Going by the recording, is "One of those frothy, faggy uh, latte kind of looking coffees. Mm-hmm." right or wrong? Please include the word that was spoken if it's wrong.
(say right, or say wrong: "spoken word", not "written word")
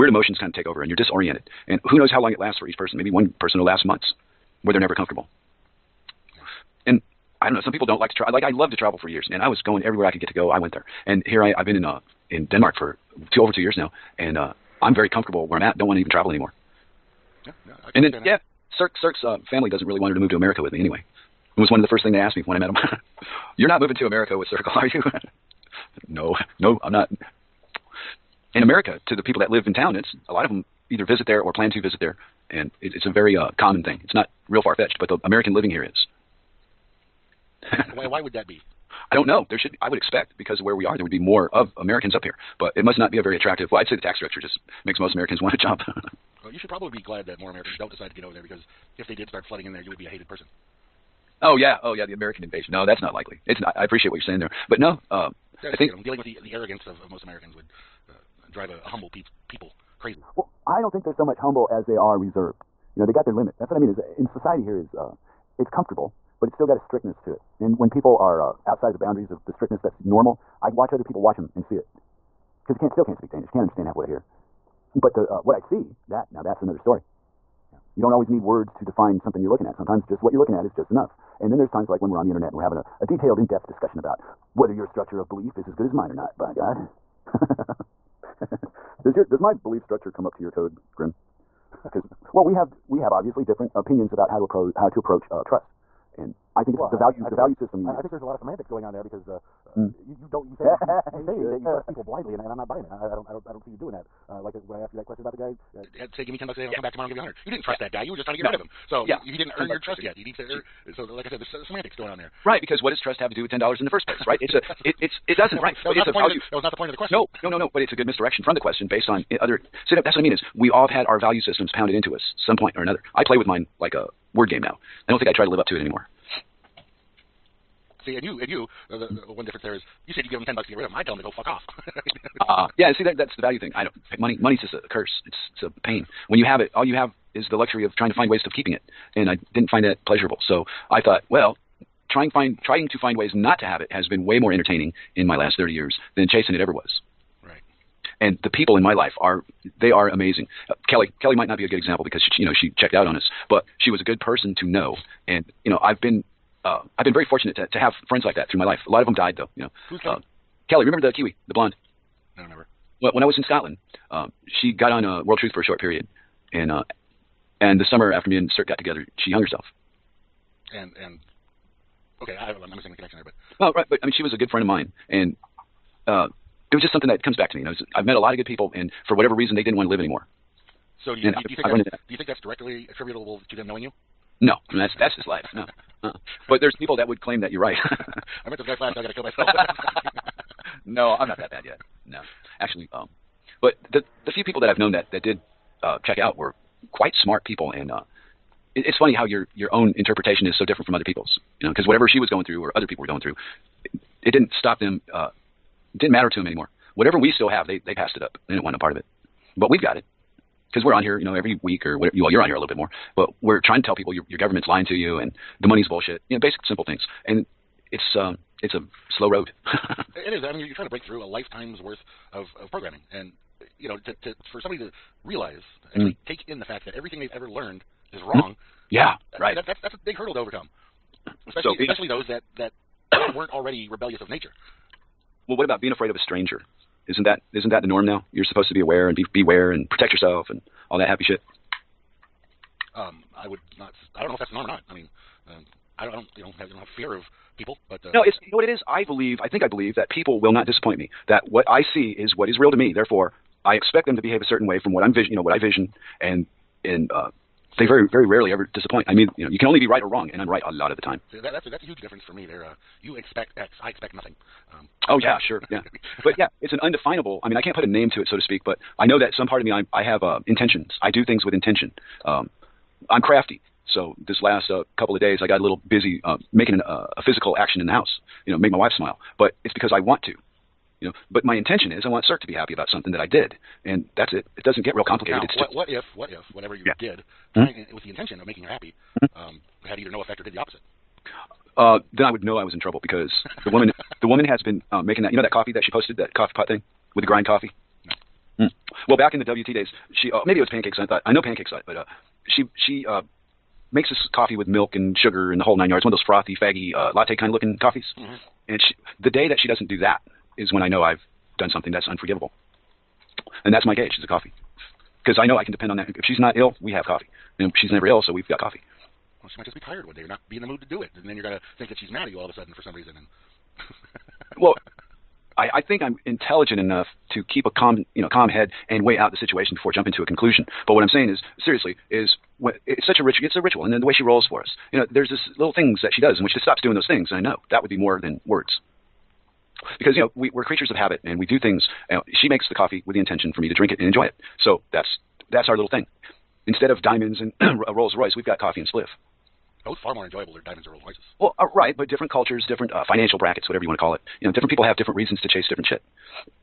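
right.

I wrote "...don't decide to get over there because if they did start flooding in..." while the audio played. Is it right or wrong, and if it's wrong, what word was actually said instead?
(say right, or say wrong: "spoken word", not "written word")
right.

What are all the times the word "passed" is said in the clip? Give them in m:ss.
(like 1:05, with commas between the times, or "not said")
3:27.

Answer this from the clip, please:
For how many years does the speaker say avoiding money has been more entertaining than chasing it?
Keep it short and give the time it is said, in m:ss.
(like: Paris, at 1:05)
30, at 2:25.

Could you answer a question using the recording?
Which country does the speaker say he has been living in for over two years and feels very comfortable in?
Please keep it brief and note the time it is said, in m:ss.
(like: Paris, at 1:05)
Denmark, at 0:12.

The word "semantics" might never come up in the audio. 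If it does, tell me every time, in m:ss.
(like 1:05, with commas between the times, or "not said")
1:38, 1:51.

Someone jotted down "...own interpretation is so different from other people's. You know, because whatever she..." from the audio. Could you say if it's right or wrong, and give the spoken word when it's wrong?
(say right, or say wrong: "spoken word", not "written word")
right.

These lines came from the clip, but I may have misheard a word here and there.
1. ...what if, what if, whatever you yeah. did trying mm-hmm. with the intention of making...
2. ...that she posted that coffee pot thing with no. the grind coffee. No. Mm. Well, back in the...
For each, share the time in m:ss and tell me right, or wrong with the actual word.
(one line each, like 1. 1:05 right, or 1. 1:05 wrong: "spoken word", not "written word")
1. 4:45 right
2. 4:55 right.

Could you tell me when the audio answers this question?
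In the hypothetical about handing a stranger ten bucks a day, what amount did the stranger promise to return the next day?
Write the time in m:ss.
1:47.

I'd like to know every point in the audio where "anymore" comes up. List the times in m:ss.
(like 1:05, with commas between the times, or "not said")
0:16, 2:05, 2:59, 3:26.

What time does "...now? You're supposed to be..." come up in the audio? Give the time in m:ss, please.
3:58.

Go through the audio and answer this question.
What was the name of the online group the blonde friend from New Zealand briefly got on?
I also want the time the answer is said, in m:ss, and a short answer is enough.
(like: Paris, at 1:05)
World Truth, at 2:45.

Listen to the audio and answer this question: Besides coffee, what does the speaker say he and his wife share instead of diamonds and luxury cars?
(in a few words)
spliff.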